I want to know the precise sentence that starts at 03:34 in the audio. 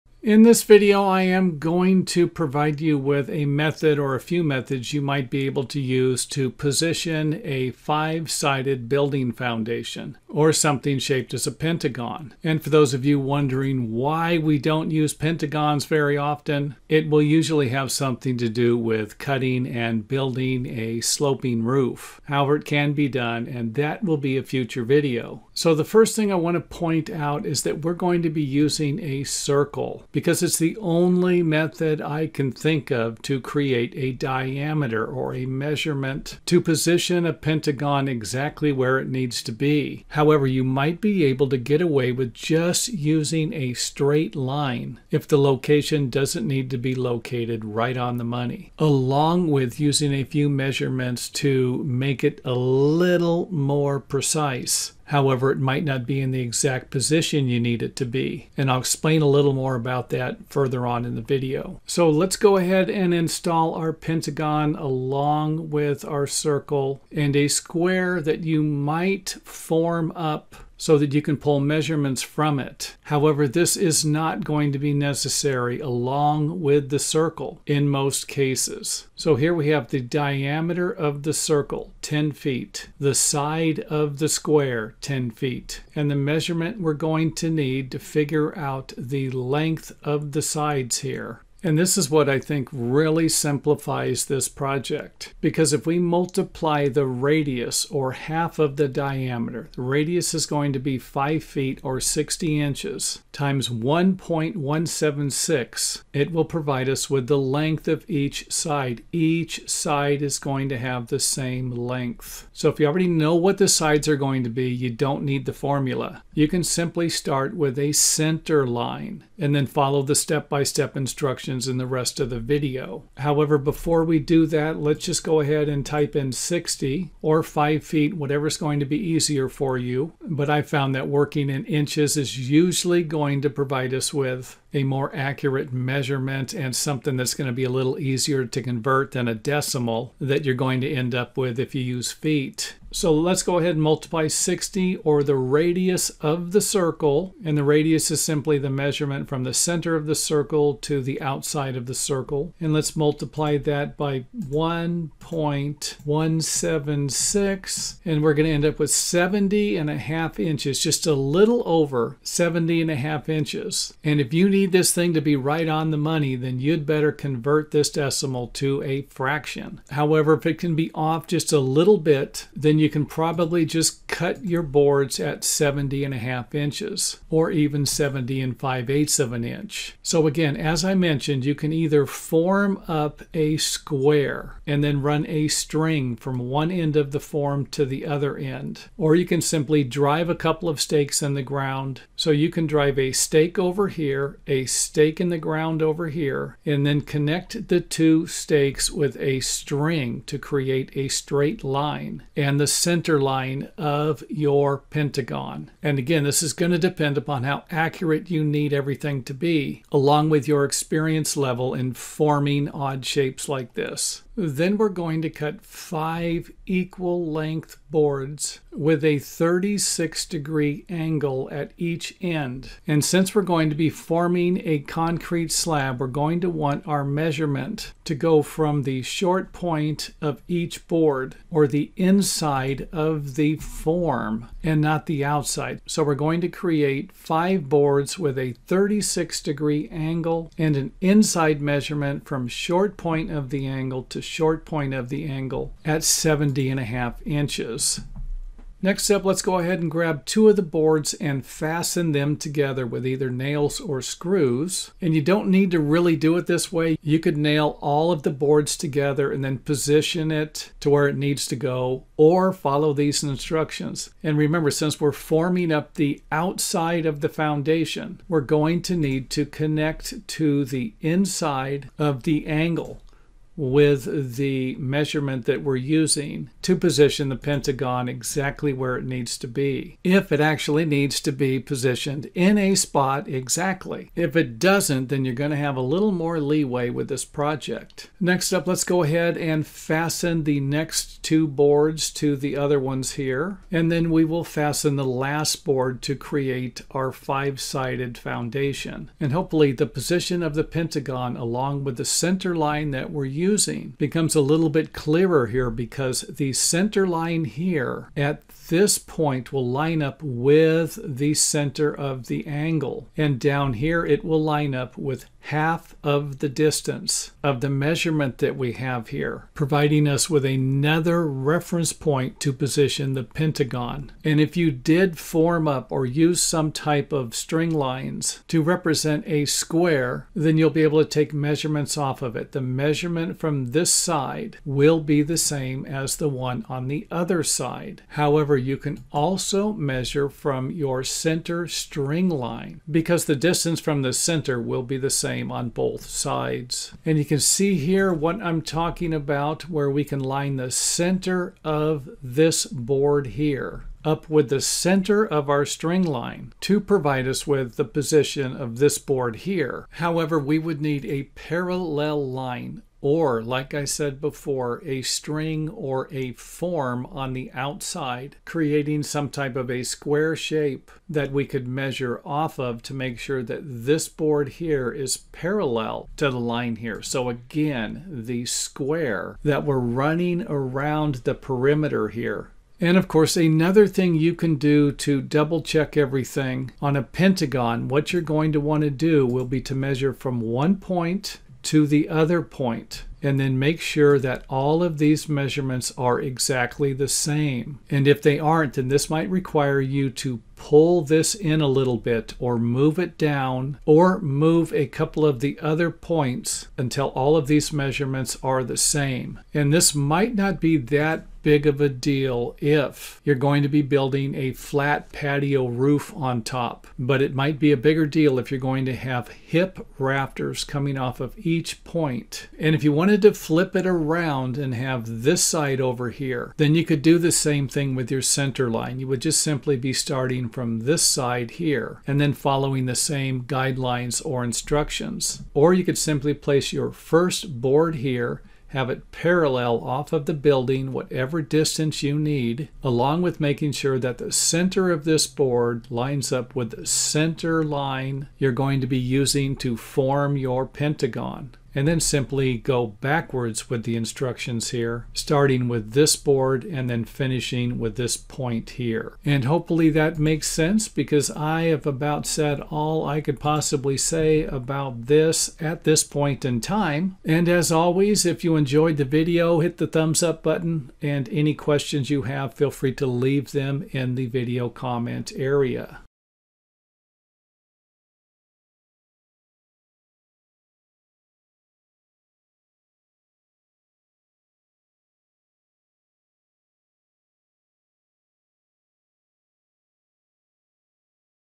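Then we're going to cut five equal length boards with a 36 degree angle at each end.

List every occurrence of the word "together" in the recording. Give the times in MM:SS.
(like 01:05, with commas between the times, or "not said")
04:12, 04:18.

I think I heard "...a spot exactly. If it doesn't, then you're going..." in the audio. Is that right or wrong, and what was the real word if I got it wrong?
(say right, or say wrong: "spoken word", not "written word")
right.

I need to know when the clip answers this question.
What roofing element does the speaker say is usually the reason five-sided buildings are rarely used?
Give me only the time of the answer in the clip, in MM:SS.
00:20.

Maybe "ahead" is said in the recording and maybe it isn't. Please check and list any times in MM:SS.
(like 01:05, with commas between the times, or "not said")
01:02, 02:05, 02:23, 04:09, 04:49.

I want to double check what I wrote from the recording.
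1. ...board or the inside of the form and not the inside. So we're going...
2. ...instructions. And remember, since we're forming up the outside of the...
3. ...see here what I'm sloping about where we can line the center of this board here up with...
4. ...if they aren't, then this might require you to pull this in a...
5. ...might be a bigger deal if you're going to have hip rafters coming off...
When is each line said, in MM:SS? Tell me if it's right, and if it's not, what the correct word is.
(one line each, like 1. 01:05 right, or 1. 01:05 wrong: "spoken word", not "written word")
1. 03:50 wrong: "outside", not "inside"
2. 04:23 right
3. 05:47 wrong: "talking", not "sloping"
4. 06:38 right
5. 06:57 right.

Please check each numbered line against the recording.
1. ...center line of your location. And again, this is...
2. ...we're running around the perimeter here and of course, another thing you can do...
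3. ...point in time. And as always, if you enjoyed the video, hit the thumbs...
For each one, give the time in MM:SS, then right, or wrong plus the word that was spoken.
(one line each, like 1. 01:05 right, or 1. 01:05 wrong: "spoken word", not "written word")
1. 03:22 wrong: "pentagon", not "location"
2. 06:19 right
3. 07:46 right.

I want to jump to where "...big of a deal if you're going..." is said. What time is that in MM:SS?
06:51.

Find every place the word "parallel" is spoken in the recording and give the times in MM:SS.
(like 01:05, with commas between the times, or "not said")
06:01, 06:15, 07:19.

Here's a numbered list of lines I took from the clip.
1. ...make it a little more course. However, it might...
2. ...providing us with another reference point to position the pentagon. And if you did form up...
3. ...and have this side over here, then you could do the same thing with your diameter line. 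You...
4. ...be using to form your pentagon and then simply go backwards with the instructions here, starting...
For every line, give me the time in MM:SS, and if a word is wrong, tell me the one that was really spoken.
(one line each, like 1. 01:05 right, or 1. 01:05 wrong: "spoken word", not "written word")
1. 00:51 wrong: "precise", not "course"
2. 05:19 right
3. 07:04 wrong: "center", not "diameter"
4. 07:28 right.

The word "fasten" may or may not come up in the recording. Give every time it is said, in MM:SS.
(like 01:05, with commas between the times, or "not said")
04:11, 04:49, 04:54.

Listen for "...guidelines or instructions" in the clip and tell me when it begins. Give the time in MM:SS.
07:13.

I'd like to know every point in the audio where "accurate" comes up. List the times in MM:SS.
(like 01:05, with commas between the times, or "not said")
02:15, 03:27.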